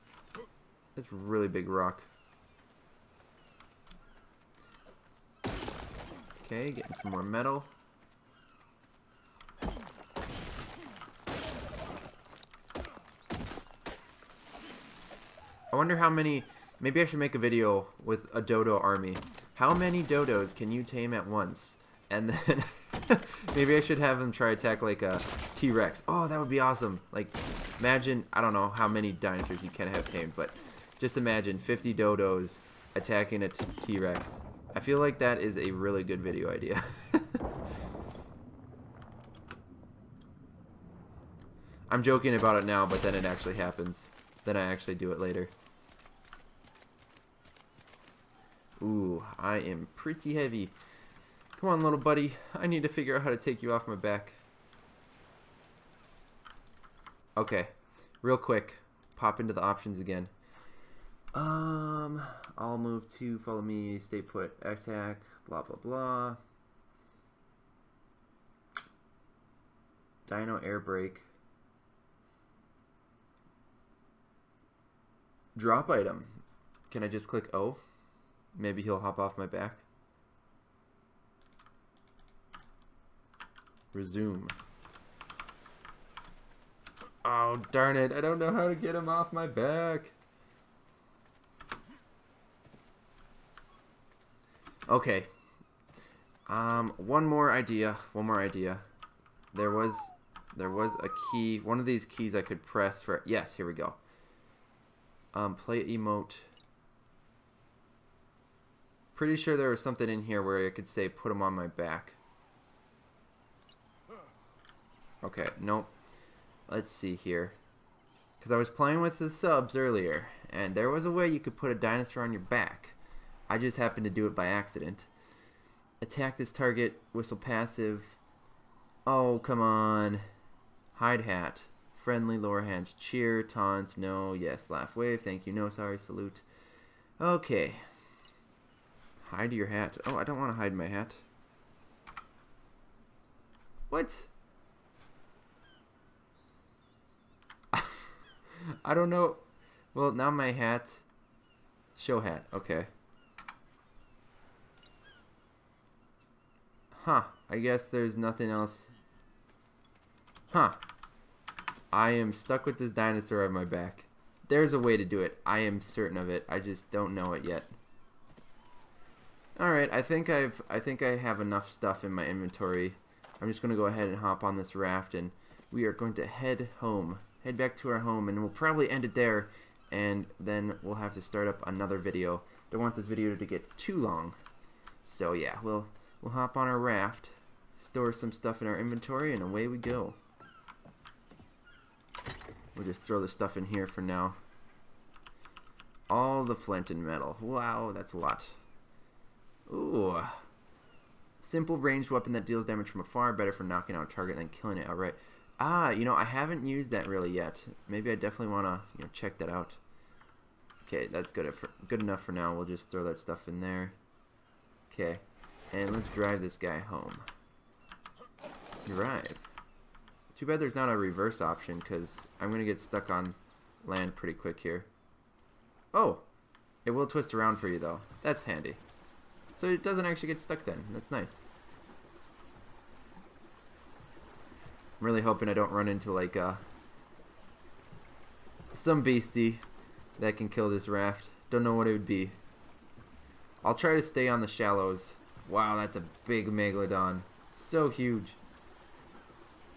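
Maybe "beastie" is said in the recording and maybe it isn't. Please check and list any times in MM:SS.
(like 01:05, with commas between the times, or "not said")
03:59.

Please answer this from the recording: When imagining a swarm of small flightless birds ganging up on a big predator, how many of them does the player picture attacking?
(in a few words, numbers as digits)
50.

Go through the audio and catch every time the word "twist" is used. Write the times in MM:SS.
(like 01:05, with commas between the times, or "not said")
03:47.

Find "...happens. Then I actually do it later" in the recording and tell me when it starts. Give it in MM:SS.
00:43.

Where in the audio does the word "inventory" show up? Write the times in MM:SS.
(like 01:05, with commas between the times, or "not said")
02:52, 03:08.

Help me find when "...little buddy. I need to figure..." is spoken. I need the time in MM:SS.
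00:51.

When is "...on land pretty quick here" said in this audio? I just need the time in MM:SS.
03:43.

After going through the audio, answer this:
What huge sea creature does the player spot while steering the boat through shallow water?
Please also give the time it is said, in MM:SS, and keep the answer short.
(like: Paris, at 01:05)
Megalodon, at 04:06.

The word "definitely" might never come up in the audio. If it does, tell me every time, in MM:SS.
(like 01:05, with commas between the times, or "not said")
03:28.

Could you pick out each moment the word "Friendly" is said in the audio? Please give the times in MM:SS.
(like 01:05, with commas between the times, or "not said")
02:11.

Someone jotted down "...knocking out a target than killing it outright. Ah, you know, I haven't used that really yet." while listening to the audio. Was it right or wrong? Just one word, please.
right.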